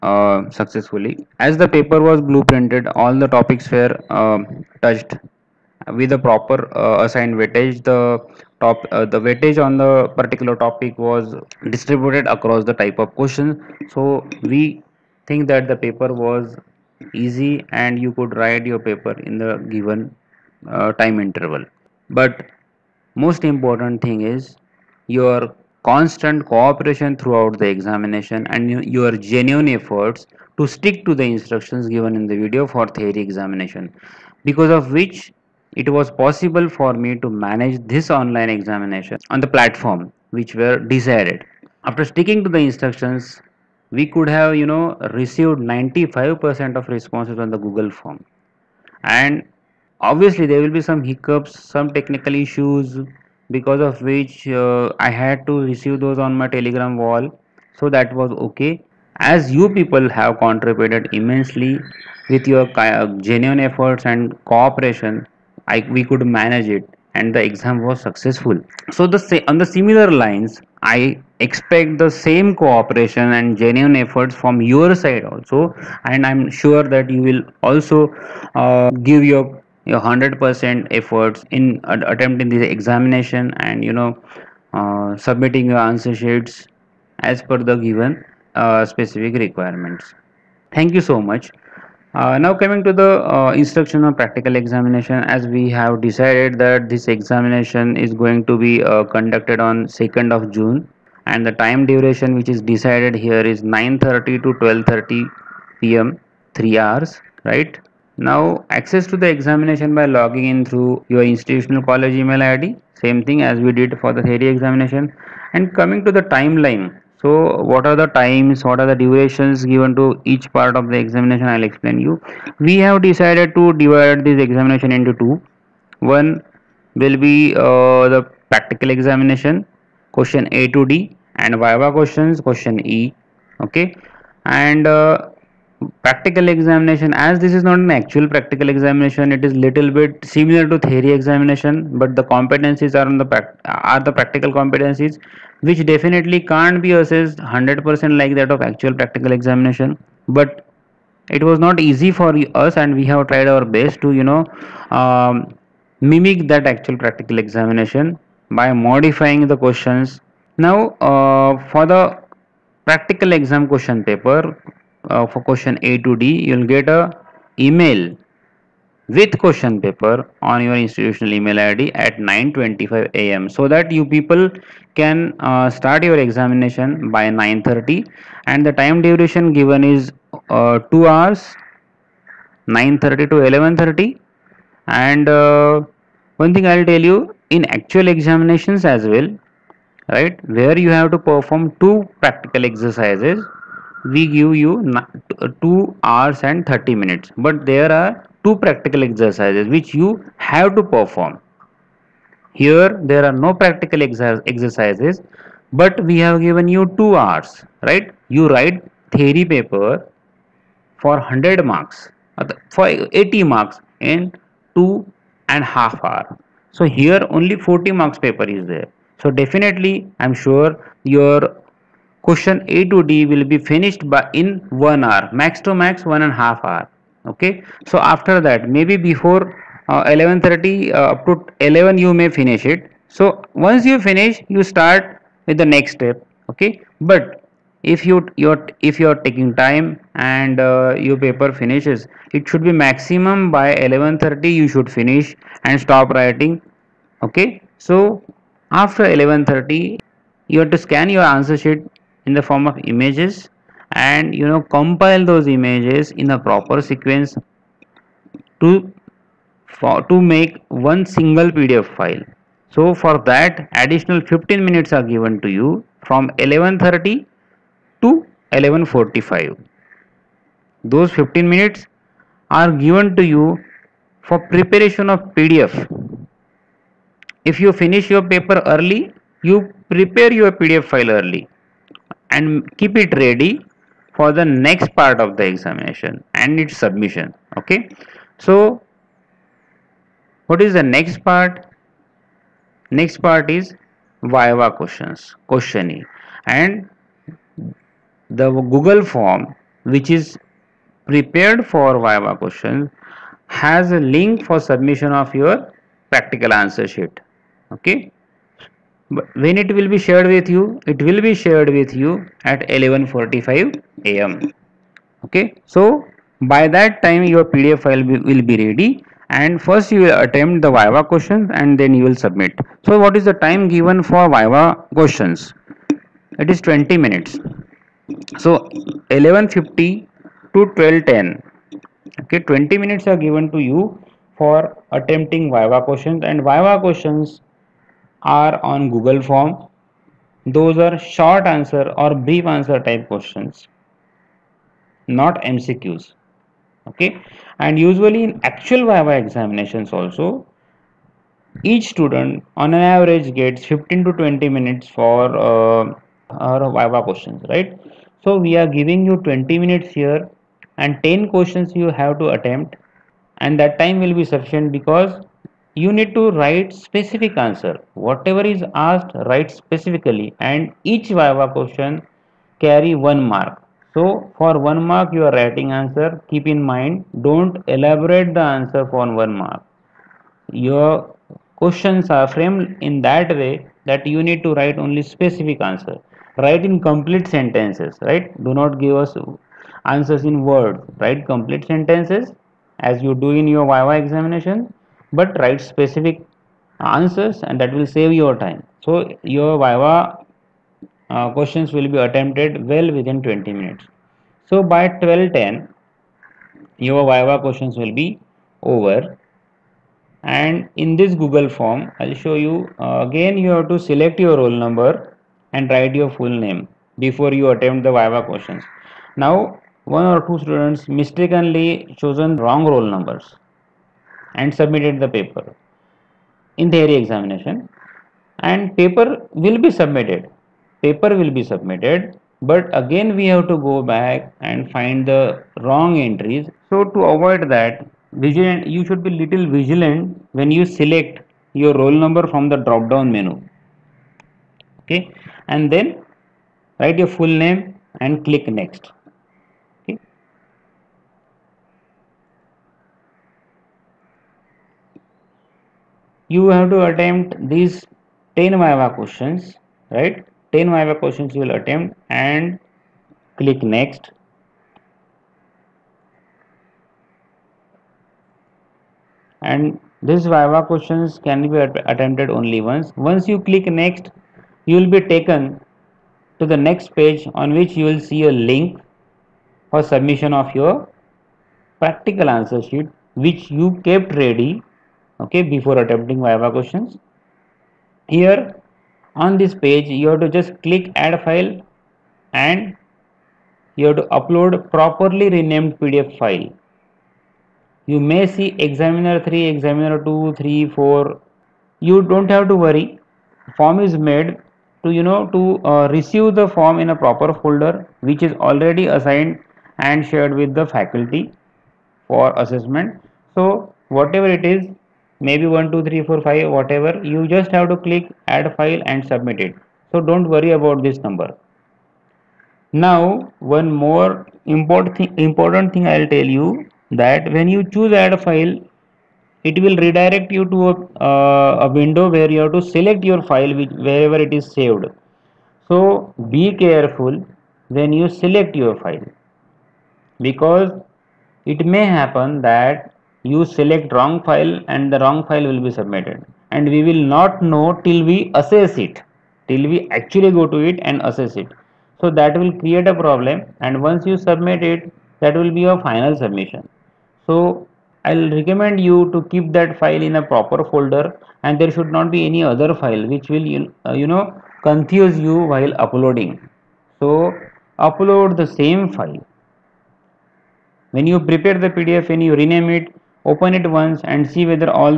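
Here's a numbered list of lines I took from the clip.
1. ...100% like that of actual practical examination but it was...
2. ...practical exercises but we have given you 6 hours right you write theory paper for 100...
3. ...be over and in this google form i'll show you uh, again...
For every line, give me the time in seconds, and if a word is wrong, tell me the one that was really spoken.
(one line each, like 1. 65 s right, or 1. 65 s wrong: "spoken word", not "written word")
1. 147 s right
2. 203 s wrong: "2", not "6"
3. 407 s right.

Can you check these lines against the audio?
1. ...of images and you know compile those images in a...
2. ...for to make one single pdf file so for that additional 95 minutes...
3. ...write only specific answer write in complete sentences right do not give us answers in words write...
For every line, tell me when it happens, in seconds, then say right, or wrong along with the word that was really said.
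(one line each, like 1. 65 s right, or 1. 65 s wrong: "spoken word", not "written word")
1. 252 s right
2. 259 s wrong: "15", not "95"
3. 384 s right.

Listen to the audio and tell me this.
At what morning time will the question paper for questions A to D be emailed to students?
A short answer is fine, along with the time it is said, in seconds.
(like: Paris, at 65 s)
9:25 a.m., at 172 s.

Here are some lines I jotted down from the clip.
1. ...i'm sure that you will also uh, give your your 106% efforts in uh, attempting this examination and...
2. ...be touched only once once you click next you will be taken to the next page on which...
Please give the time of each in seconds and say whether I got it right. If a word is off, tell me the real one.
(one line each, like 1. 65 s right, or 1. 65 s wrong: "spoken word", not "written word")
1. 76 s wrong: "100", not "106"
2. 471 s wrong: "attempted", not "touched".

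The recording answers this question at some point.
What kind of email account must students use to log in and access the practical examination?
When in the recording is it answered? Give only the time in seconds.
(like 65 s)
111 s.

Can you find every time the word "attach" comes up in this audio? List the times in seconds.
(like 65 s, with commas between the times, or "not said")
not said.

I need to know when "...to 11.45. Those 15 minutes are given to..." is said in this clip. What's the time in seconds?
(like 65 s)
268 s.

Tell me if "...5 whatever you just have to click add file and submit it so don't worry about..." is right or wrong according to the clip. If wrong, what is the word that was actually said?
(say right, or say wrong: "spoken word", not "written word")
right.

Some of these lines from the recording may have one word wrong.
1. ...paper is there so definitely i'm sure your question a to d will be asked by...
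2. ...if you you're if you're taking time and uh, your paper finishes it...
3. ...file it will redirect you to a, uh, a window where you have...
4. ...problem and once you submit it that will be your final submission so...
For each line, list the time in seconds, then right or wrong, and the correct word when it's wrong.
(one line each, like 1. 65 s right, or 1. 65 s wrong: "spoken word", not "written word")
1. 218 s wrong: "finished", not "asked"
2. 237 s right
3. 528 s right
4. 553 s right.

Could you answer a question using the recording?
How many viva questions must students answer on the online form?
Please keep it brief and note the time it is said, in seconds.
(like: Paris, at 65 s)
10, at 361 s.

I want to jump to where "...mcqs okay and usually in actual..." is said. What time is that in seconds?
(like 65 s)
345 s.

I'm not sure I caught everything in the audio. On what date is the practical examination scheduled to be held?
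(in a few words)
2nd of June.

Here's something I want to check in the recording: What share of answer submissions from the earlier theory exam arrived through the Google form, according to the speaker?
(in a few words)
95%.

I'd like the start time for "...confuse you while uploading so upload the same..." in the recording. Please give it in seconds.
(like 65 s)
564 s.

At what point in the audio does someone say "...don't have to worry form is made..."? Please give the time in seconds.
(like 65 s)
502 s.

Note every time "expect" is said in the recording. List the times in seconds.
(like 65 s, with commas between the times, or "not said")
71 s.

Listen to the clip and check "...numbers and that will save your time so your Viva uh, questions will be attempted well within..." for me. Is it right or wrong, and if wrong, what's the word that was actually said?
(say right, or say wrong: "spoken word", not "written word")
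wrong: "answers", not "numbers".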